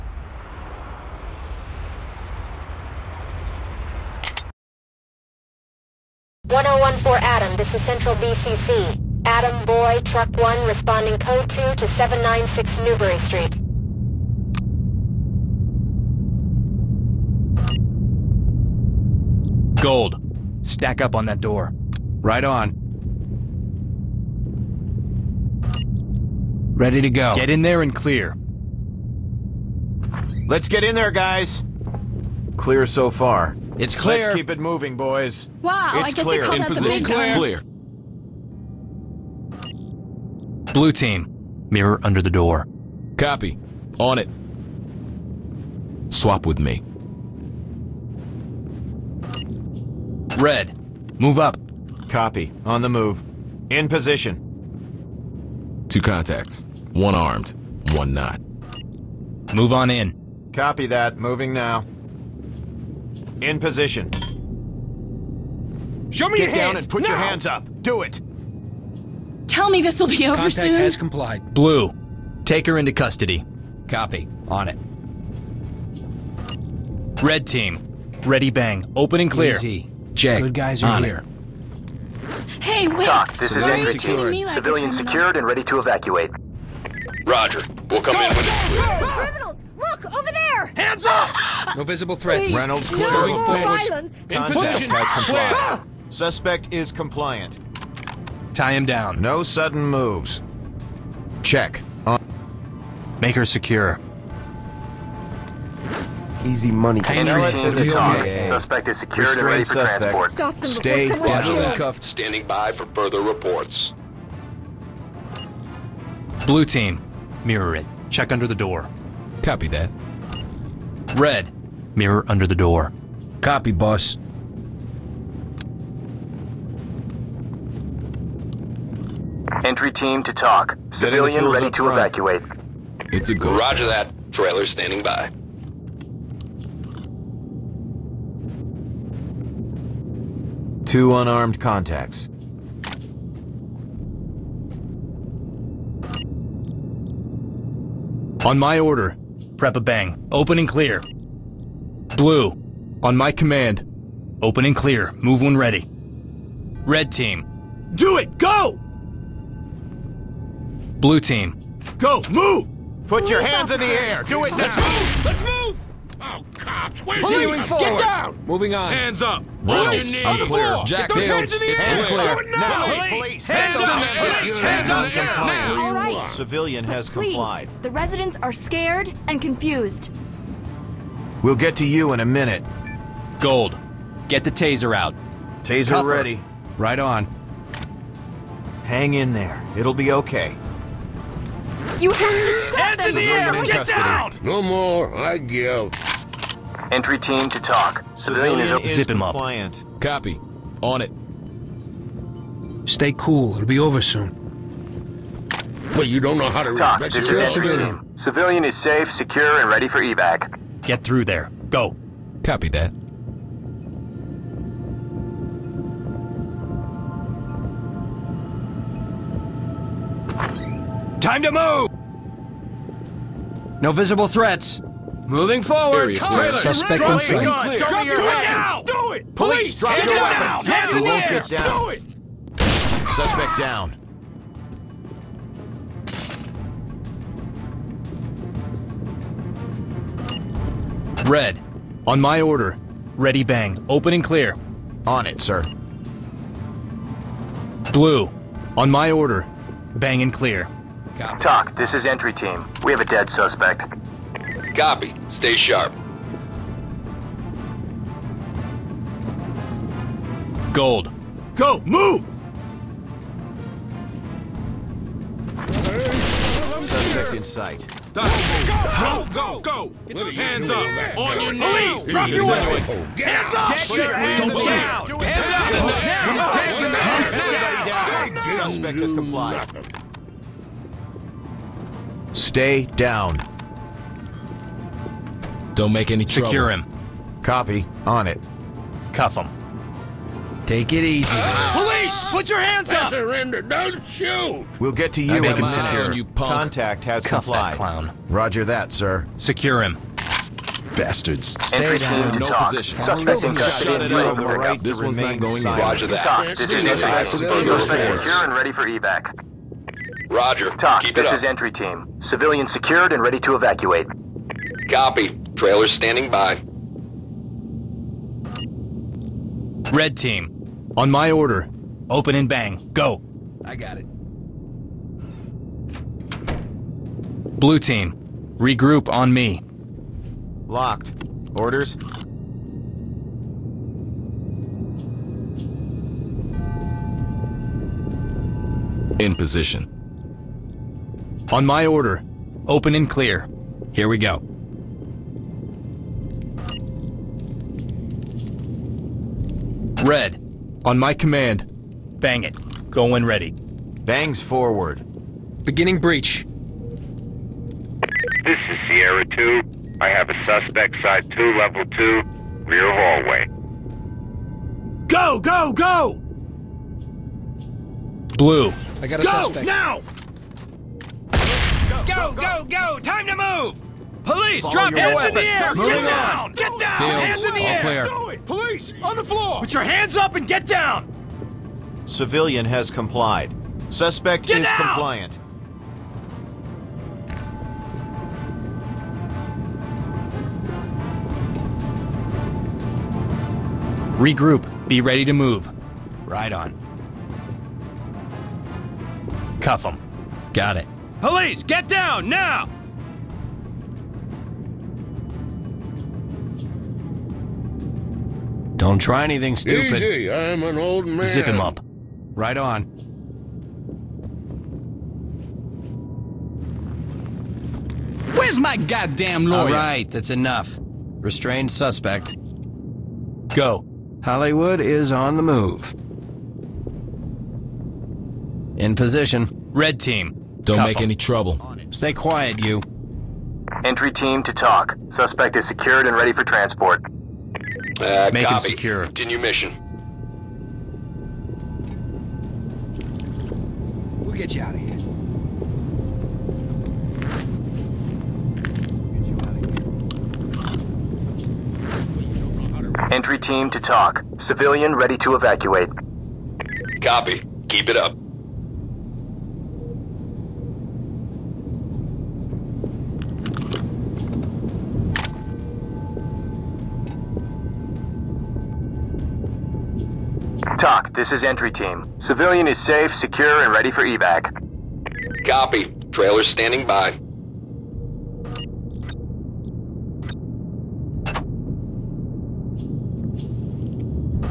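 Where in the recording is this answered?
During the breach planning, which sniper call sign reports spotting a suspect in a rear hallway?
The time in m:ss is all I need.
5:58.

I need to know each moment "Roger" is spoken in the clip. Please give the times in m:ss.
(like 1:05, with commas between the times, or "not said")
1:27, 2:13, 4:58, 5:05, 5:10.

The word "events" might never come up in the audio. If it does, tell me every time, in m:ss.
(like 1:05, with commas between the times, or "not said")
not said.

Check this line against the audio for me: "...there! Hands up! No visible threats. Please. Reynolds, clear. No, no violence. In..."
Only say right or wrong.
right.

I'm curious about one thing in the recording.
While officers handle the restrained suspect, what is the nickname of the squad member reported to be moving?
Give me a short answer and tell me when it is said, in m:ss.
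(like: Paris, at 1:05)
Hollywood, at 7:04.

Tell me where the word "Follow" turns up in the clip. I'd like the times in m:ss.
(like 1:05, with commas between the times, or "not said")
6:14.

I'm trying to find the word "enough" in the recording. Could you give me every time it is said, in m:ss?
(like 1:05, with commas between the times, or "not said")
7:00.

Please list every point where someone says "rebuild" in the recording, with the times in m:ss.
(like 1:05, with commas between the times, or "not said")
not said.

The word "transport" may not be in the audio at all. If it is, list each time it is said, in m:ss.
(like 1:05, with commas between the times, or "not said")
1:49, 7:16.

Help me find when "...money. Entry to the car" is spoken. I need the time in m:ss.
1:46.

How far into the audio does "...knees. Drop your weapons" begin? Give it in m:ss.
4:31.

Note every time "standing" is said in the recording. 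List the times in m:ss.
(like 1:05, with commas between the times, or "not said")
1:52, 2:14, 5:15, 7:56.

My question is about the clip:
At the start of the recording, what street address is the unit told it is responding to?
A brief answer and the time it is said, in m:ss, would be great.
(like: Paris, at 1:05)
796 Newbury Street, at 0:11.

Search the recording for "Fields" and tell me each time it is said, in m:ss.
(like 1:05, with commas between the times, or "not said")
2:51.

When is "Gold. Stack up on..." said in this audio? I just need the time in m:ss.
0:19.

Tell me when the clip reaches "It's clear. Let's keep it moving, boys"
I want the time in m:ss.
0:33.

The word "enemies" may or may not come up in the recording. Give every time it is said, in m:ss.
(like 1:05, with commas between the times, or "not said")
not said.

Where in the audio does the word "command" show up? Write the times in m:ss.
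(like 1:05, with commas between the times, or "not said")
2:33, 5:51.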